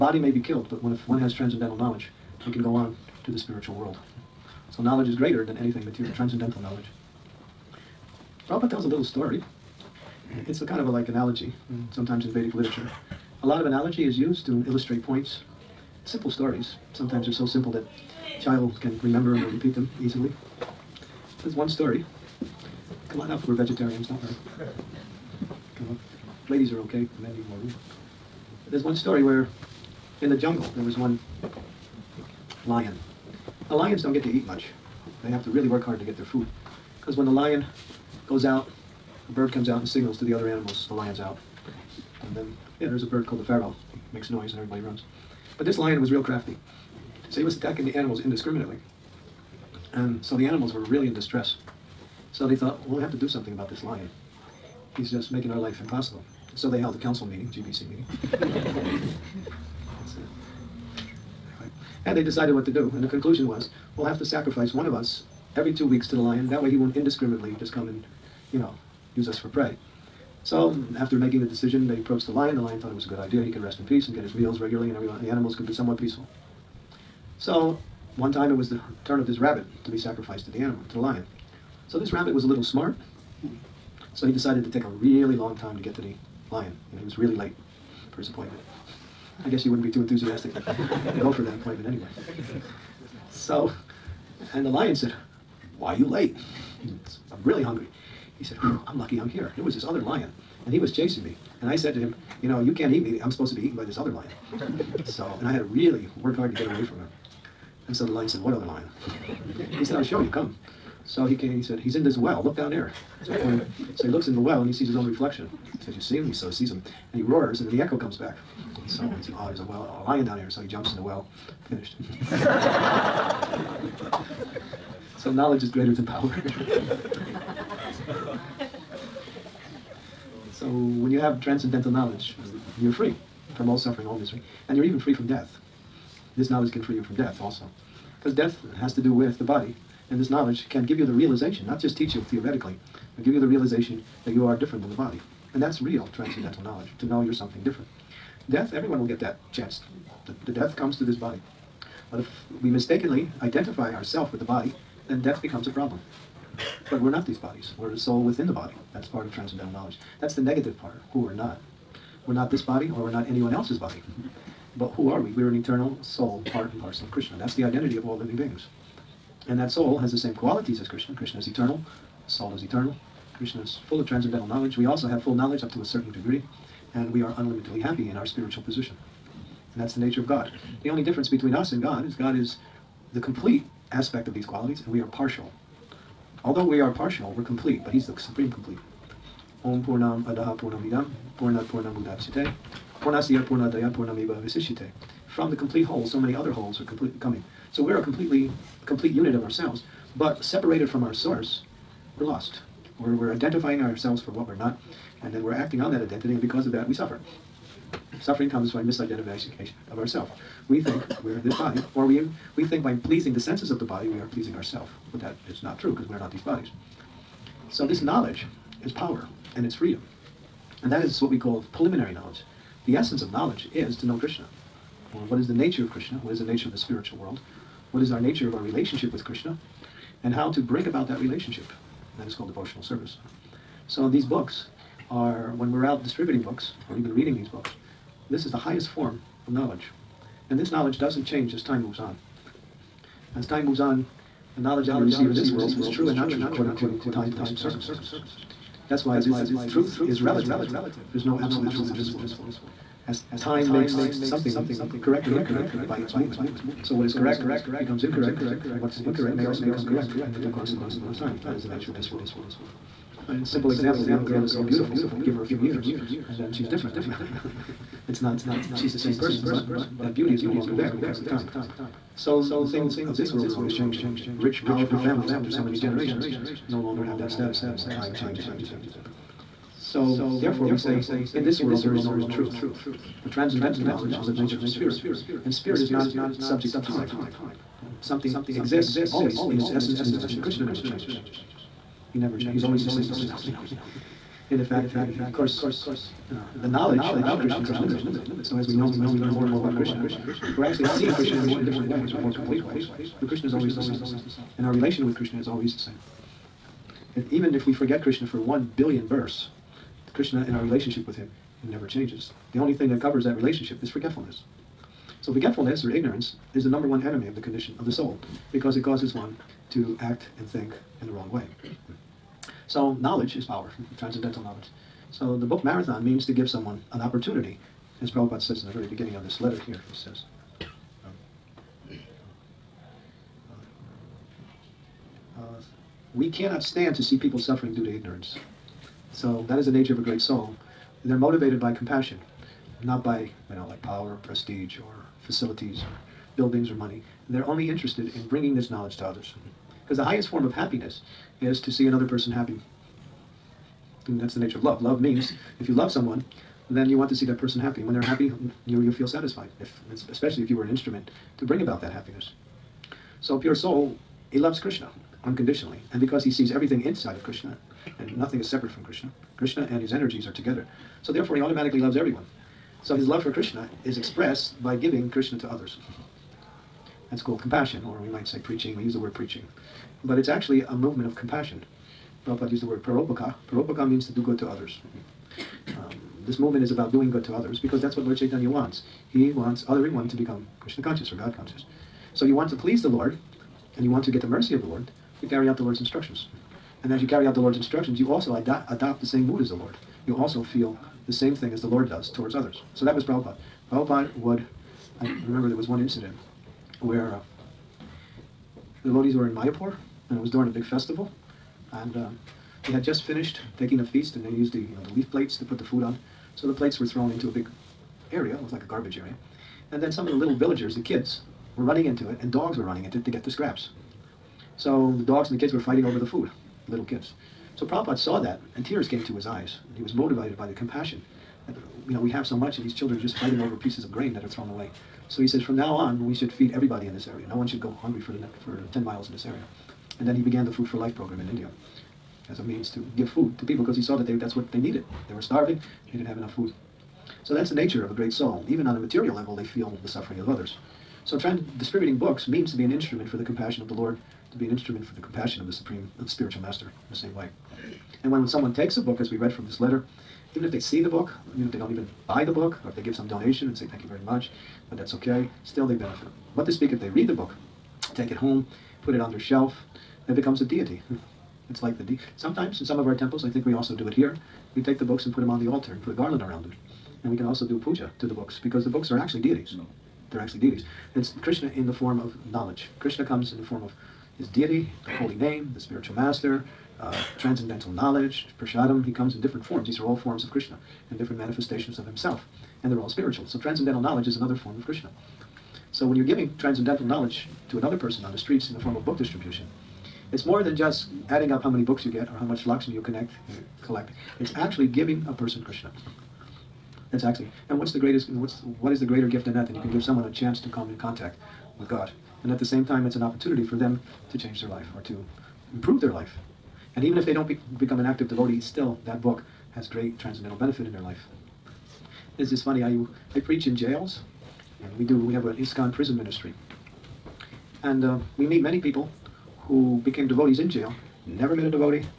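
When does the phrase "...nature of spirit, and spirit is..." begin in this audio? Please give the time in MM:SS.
04:44.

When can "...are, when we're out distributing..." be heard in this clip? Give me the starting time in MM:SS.
03:55.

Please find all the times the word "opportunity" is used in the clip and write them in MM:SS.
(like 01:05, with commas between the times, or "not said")
05:27, 08:33.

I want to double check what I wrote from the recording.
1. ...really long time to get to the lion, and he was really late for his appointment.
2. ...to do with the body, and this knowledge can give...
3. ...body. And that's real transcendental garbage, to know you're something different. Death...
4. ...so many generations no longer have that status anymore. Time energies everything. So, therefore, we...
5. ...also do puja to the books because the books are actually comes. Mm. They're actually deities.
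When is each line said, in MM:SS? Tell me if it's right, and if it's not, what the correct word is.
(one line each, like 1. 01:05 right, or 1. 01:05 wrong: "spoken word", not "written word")
1. 01:24 right
2. 02:18 right
3. 02:24 wrong: "knowledge", not "garbage"
4. 04:35 wrong: "changes", not "energies"
5. 07:57 wrong: "deities", not "comes".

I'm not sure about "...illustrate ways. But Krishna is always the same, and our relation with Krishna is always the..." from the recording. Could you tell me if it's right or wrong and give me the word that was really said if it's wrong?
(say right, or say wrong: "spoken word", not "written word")
wrong: "complete", not "illustrate".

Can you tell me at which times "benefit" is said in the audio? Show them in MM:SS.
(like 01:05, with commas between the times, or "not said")
07:45, 08:40.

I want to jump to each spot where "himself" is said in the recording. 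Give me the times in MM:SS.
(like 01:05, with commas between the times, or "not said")
08:11.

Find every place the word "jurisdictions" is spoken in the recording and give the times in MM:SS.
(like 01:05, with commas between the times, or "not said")
not said.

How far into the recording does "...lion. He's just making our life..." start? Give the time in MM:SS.
00:53.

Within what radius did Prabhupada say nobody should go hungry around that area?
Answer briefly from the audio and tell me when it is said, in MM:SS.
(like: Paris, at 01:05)
10 miles, at 07:18.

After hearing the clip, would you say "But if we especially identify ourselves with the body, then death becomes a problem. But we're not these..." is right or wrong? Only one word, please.
wrong.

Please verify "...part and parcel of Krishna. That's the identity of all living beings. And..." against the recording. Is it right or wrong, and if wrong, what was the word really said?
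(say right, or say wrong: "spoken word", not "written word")
right.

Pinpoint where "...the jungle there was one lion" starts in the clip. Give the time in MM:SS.
00:30.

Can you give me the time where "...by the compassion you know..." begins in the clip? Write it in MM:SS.
07:10.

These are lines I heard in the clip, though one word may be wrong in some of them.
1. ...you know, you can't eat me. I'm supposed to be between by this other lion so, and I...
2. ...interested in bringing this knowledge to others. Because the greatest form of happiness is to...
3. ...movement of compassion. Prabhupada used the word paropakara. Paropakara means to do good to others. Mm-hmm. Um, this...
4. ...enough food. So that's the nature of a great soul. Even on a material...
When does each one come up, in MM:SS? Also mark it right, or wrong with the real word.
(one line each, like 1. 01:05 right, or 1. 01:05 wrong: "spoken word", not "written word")
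1. 01:42 wrong: "eaten", not "between"
2. 05:47 wrong: "highest", not "greatest"
3. 06:20 right
4. 07:26 right.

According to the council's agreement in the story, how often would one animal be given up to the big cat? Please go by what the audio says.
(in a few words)
every two weeks.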